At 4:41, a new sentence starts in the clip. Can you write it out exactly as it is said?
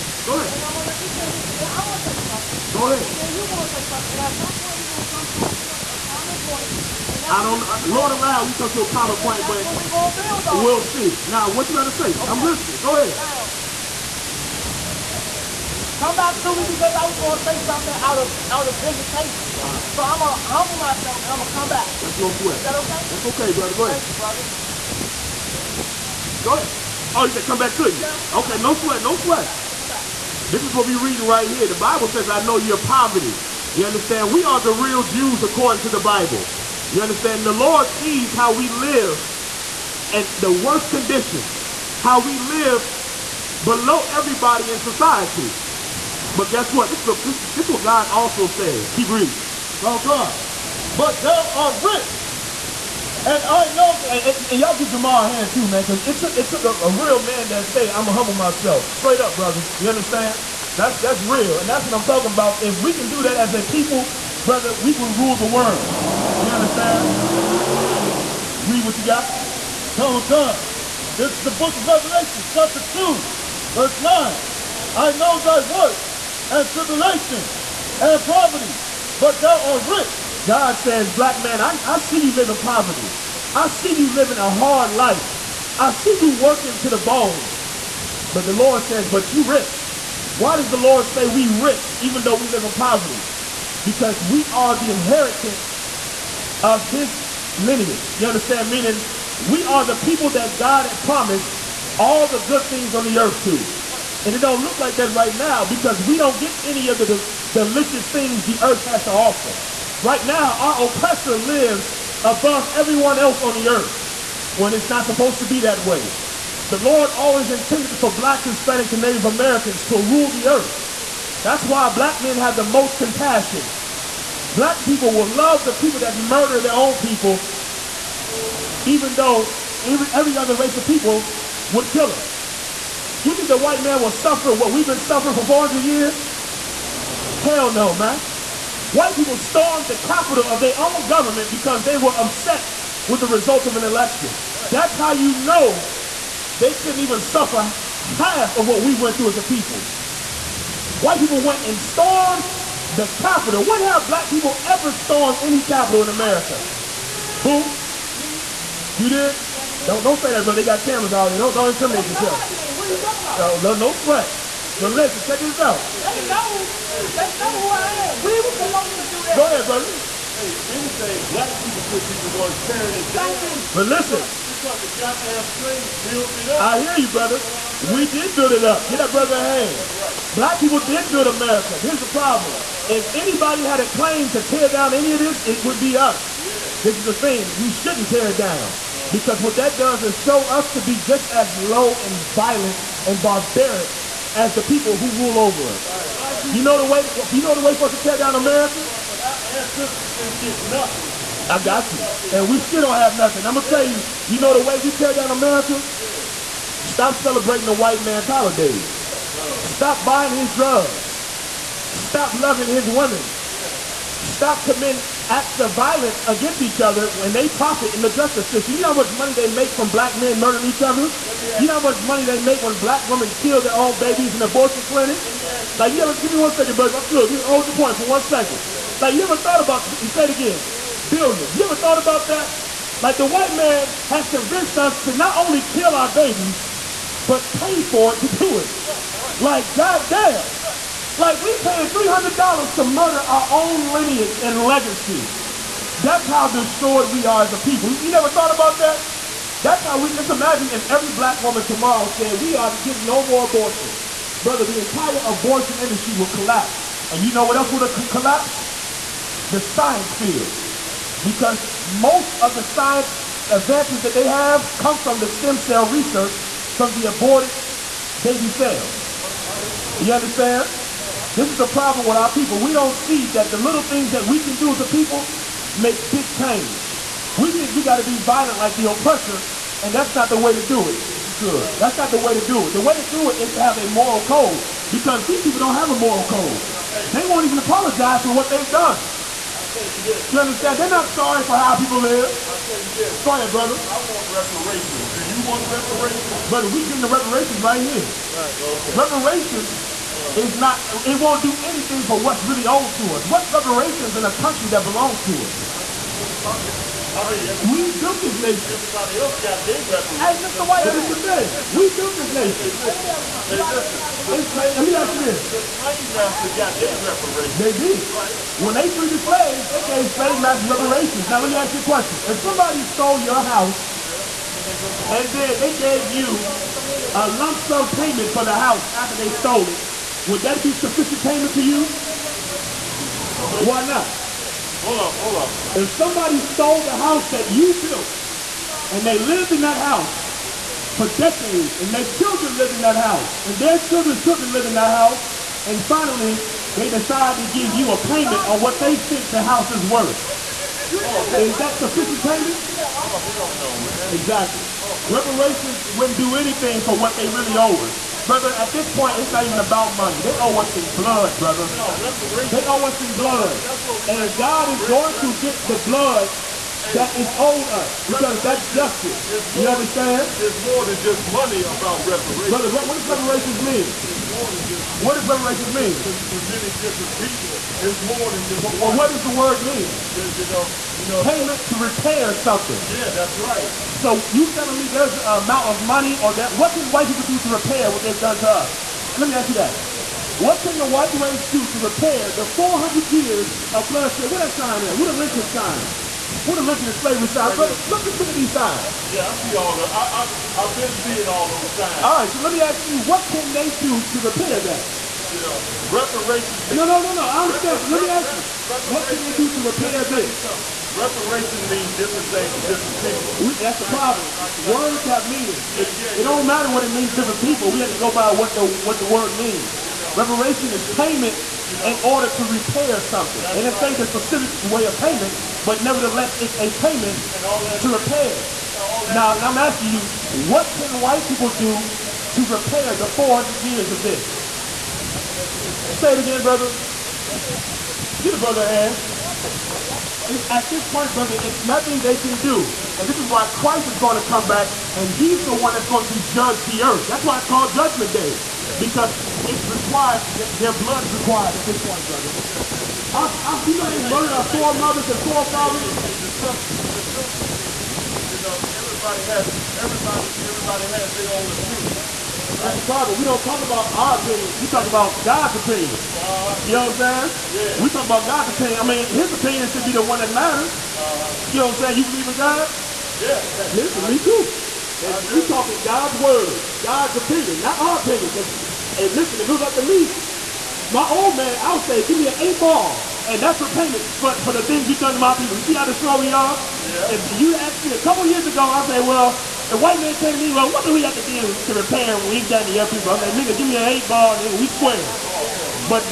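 If you could, that's not the way to do it.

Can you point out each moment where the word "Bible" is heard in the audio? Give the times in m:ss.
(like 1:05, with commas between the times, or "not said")
0:31, 0:36.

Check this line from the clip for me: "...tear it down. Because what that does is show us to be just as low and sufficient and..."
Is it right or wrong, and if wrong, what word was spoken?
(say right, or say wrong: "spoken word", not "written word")
wrong: "violent", not "sufficient".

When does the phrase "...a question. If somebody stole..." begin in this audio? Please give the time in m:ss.
5:21.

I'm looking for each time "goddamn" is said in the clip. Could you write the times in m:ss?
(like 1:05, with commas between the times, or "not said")
2:54, 3:59.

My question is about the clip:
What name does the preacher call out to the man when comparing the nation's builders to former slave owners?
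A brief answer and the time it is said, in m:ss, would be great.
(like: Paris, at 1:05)
Mr. White, at 5:10.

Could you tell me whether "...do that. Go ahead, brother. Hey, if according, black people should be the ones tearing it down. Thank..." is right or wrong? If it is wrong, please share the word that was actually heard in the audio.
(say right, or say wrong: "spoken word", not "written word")
wrong: "anything", not "according".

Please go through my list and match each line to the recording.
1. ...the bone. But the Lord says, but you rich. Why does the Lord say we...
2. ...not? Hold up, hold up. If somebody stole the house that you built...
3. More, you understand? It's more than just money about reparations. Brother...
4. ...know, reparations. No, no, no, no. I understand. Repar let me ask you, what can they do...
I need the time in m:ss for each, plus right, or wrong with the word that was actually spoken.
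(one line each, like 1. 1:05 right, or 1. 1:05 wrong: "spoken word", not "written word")
1. 1:26 right
2. 5:33 right
3. 6:09 right
4. 6:45 right.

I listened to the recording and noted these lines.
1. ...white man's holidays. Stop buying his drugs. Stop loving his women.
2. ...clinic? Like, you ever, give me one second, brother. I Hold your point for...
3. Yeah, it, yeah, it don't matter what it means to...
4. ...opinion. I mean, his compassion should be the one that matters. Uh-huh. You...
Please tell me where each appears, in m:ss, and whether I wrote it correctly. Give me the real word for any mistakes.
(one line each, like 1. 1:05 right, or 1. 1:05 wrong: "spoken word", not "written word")
1. 3:27 right
2. 3:44 right
3. 6:55 right
4. 7:48 wrong: "opinion", not "compassion".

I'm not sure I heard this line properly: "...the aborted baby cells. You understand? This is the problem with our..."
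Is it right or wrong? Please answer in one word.
right.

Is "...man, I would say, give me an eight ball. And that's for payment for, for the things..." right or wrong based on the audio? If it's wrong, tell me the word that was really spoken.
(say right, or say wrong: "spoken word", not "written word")
right.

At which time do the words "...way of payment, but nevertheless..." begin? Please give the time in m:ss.
7:04.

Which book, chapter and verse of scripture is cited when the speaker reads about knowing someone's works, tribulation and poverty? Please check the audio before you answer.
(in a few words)
Revelations 2:9.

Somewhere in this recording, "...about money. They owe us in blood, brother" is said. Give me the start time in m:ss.
5:59.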